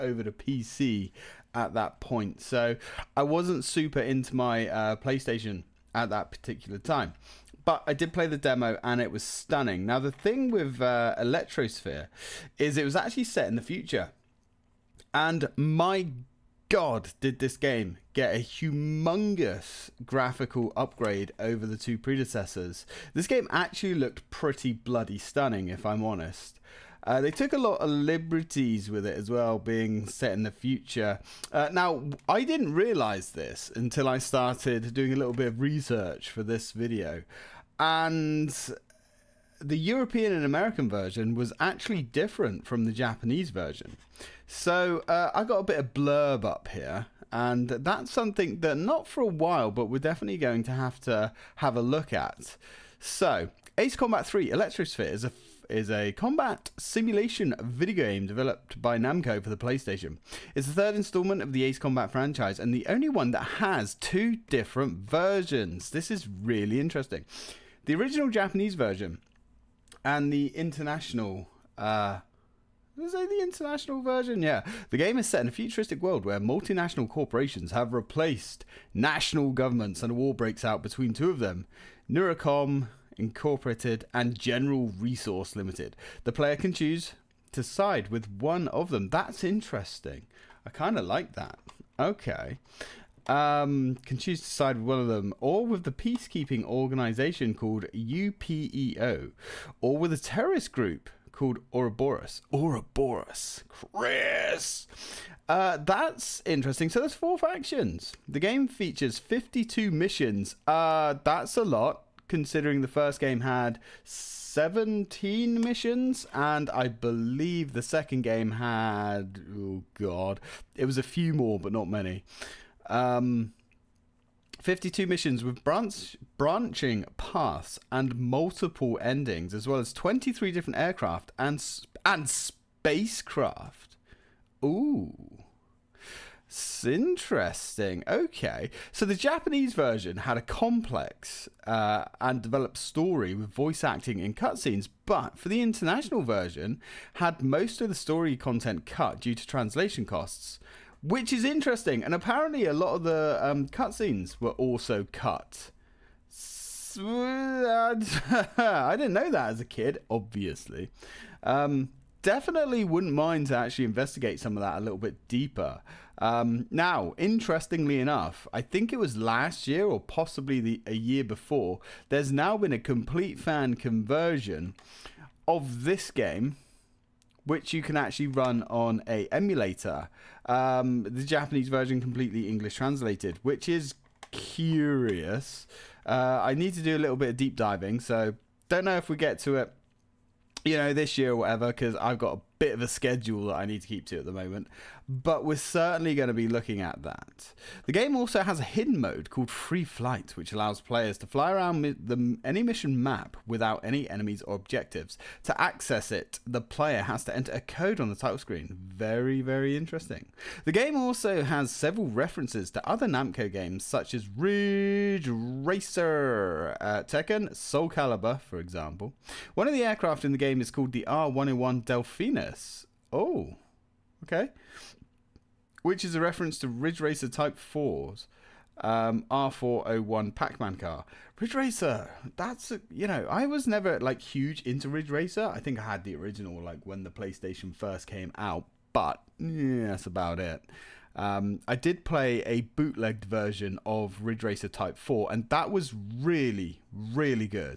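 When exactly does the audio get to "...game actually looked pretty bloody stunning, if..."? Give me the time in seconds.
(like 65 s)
23 s.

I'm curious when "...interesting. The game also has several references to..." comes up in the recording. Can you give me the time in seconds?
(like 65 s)
209 s.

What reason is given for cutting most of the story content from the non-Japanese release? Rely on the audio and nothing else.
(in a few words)
Translation costs.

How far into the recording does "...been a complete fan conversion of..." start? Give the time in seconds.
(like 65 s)
172 s.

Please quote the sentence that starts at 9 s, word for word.
Now, the thing with uh, Electrosphere is it was actually set in the future.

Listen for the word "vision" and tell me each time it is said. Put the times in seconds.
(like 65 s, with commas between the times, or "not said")
not said.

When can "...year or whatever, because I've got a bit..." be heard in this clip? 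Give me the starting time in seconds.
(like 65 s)
191 s.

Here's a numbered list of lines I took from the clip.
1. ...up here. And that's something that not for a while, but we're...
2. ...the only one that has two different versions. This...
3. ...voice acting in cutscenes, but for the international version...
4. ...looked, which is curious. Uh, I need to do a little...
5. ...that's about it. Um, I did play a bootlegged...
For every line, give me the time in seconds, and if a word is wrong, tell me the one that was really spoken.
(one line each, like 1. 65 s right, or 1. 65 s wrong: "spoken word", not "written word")
1. 46 s right
2. 62 s right
3. 143 s right
4. 182 s wrong: "translated", not "looked"
5. 239 s right.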